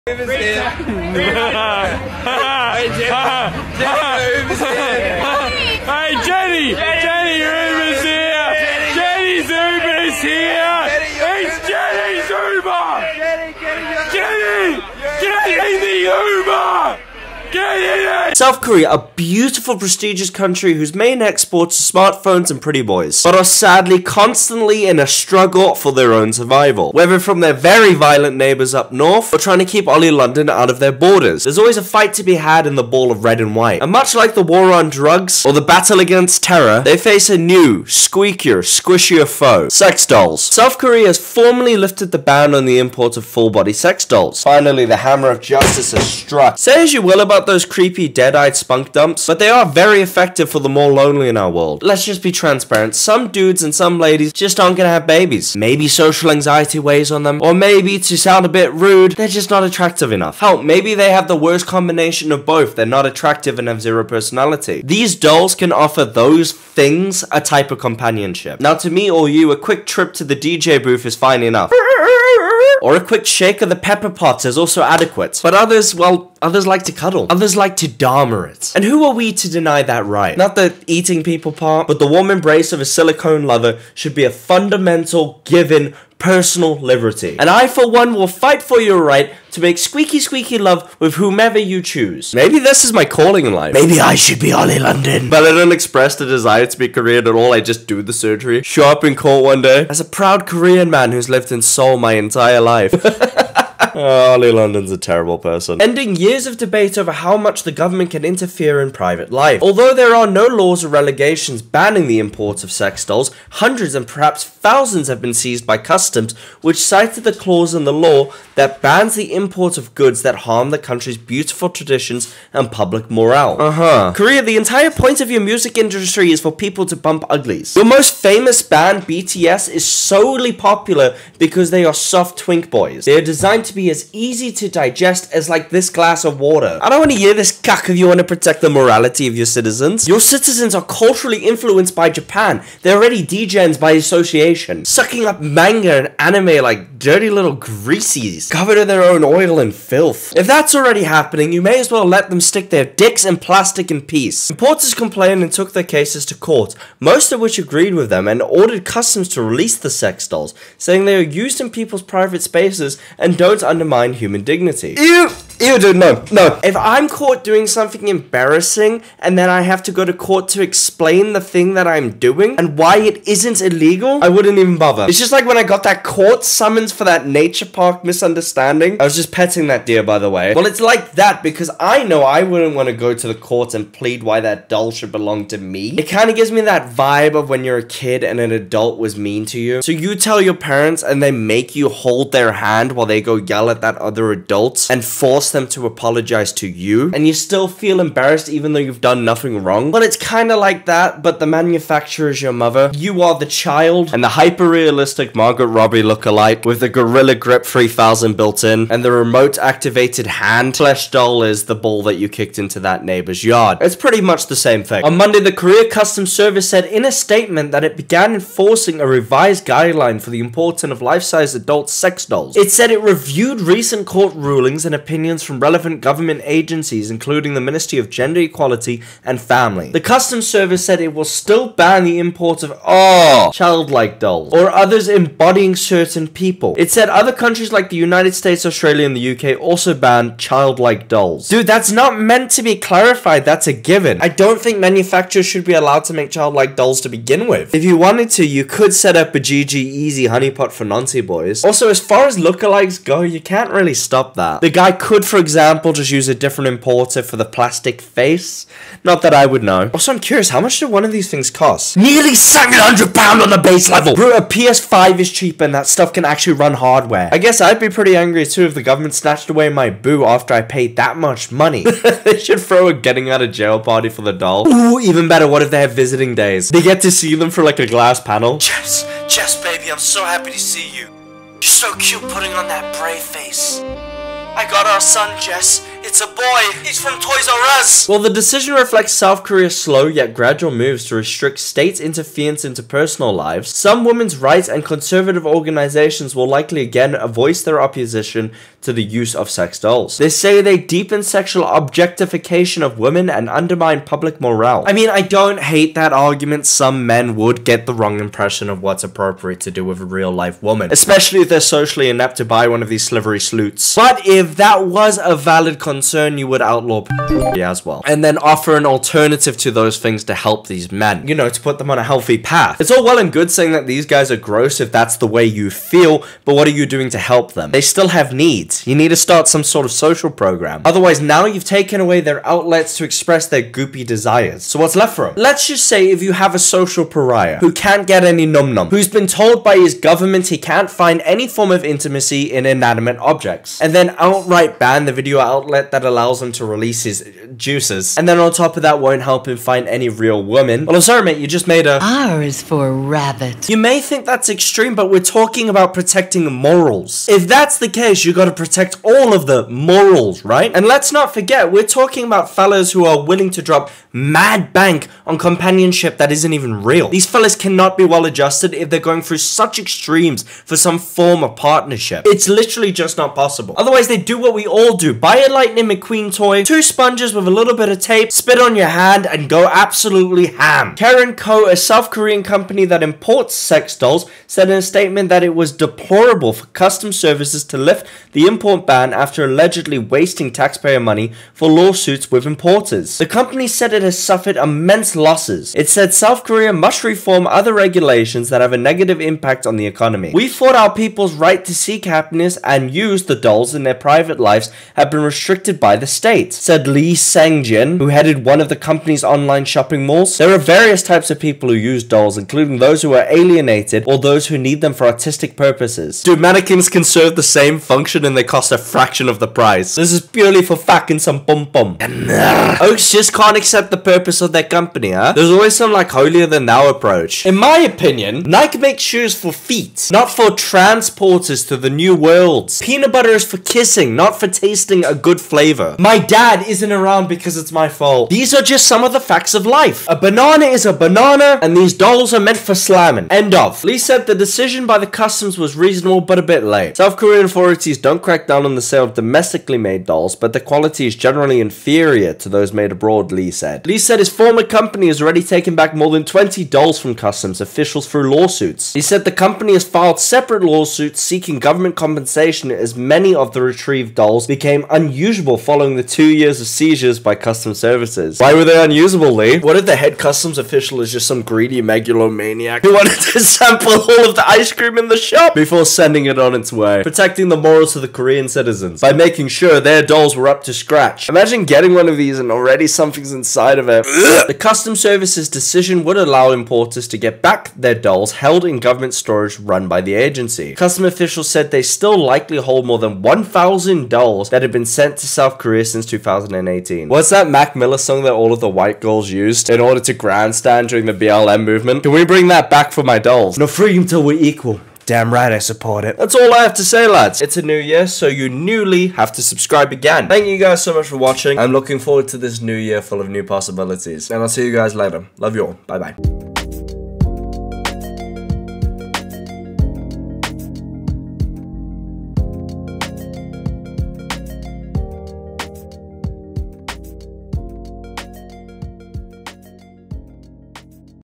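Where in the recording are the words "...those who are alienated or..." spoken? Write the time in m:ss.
6:52.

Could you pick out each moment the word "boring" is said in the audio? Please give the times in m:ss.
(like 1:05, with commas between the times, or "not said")
not said.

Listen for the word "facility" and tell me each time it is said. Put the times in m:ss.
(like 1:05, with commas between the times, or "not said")
not said.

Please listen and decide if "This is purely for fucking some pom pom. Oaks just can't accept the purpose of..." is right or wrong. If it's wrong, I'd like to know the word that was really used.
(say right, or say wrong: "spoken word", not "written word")
right.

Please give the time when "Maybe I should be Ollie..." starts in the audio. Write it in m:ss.
1:33.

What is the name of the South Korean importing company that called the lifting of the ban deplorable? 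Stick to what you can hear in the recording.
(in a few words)
Karen Co.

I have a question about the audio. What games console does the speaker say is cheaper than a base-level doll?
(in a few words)
PS5.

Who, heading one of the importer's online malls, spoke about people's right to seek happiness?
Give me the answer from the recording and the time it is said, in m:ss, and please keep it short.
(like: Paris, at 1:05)
Lee Sangjin, at 6:46.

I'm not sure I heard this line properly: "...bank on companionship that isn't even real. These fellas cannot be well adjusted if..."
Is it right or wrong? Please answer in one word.
right.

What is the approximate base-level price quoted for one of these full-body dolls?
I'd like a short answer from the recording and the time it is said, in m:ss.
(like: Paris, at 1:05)
700 pounds, at 4:22.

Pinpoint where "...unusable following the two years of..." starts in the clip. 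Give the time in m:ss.
7:45.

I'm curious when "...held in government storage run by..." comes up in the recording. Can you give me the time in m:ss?
8:08.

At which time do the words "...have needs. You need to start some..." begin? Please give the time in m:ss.
5:28.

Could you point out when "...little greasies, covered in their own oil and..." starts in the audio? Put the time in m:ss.
2:27.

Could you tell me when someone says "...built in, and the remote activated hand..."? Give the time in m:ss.
3:28.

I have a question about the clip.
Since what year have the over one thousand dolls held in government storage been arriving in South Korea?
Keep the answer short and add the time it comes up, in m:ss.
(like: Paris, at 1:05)
2018, at 8:16.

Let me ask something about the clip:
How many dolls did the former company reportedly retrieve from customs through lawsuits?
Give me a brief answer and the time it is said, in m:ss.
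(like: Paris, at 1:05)
More than 20, at 7:35.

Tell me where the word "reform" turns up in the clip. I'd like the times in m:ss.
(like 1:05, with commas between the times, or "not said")
6:37.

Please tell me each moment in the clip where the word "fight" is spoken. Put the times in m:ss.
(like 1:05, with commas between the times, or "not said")
0:31, 1:28.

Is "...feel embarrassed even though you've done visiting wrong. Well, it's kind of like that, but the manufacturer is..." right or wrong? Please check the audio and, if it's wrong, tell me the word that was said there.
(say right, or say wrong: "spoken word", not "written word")
wrong: "nothing", not "visiting".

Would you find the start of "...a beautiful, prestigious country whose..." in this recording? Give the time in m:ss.
0:18.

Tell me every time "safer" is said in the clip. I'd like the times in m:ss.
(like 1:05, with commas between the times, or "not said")
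not said.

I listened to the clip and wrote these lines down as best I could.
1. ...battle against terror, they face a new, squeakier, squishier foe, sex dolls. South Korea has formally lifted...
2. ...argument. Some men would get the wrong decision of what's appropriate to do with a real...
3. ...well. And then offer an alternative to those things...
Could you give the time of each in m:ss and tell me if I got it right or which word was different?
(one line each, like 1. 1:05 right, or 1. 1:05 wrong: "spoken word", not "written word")
1. 0:35 right
2. 5:06 wrong: "impression", not "decision"
3. 5:17 right.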